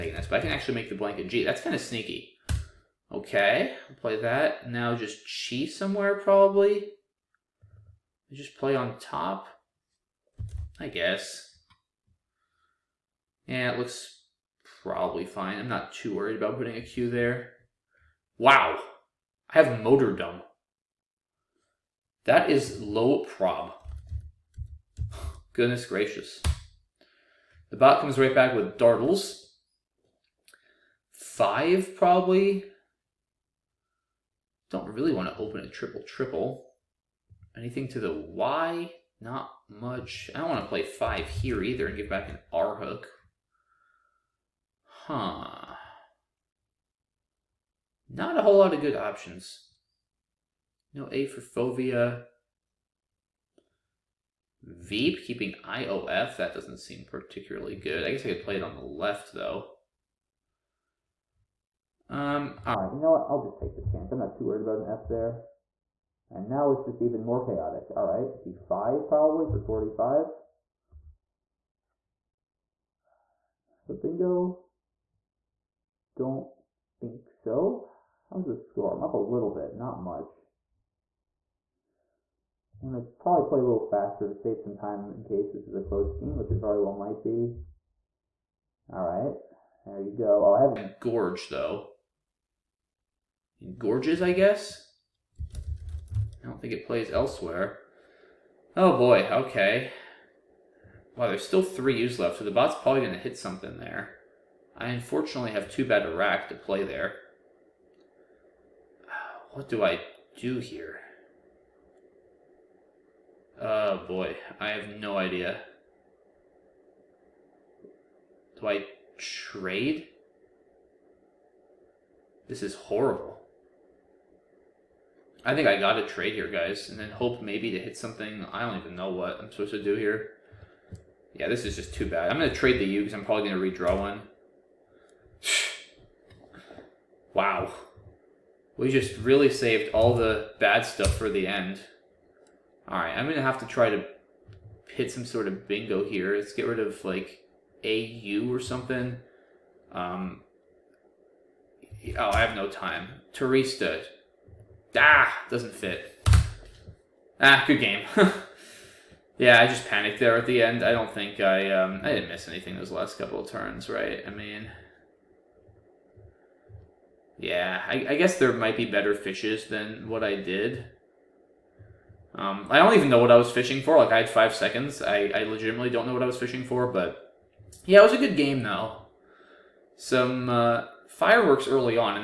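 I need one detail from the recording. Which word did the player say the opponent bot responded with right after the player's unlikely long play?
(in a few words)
dartles.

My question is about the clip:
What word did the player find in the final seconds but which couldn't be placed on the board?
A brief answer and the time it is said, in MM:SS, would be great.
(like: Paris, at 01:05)
Turista, at 02:33.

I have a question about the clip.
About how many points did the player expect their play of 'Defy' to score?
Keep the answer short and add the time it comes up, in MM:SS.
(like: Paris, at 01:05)
45, at 01:09.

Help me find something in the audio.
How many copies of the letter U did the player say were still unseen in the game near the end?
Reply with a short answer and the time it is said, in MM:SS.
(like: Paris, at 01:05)
3, at 01:41.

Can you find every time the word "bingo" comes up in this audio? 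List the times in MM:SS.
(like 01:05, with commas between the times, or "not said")
01:13, 02:25.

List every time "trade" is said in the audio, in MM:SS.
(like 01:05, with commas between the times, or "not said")
01:59, 02:06, 02:12.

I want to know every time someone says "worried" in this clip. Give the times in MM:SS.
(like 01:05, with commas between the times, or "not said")
00:16, 01:04.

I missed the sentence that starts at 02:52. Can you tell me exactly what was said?
Um, I don't even know what I was fishing for.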